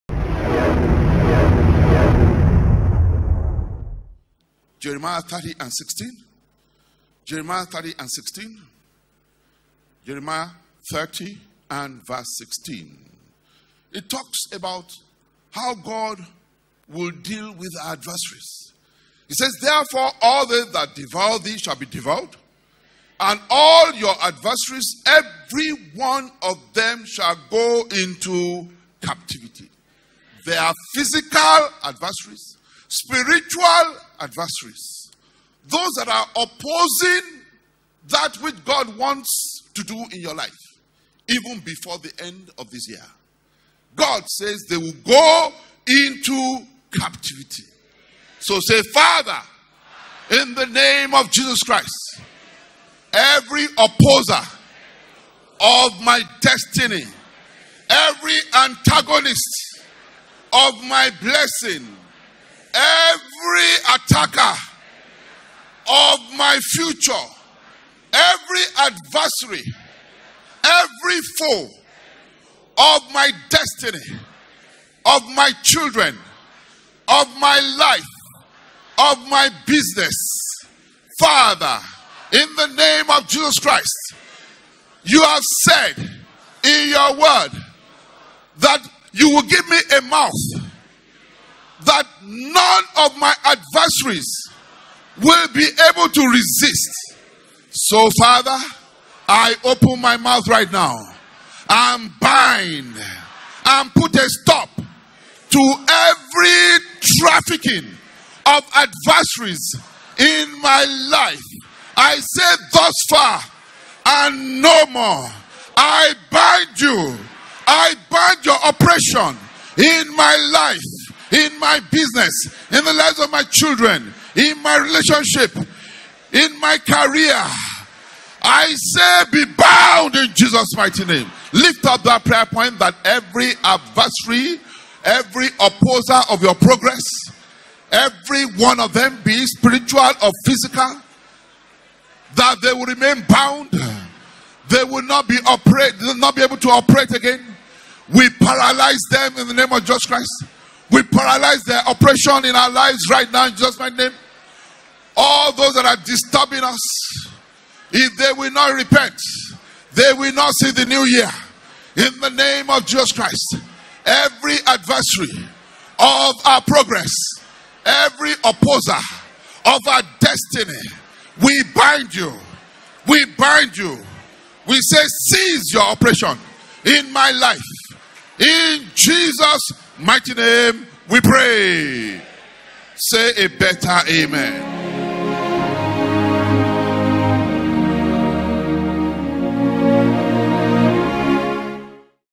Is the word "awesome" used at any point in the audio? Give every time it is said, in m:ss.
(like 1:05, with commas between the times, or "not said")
not said.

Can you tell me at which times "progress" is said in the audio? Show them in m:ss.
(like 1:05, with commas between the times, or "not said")
2:16, 2:46.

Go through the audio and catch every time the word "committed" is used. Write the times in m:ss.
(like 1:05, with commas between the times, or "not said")
not said.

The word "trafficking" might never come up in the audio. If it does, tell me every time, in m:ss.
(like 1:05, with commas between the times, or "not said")
1:47.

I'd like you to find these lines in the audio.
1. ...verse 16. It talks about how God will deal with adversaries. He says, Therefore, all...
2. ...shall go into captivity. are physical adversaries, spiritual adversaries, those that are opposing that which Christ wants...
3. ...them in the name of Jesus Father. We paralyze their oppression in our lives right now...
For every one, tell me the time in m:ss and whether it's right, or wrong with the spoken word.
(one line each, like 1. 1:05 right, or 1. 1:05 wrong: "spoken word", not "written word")
1. 0:12 right
2. 0:27 wrong: "God", not "Christ"
3. 2:29 wrong: "Christ", not "Father".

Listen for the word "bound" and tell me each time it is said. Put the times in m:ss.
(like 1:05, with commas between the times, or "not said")
2:09, 2:23.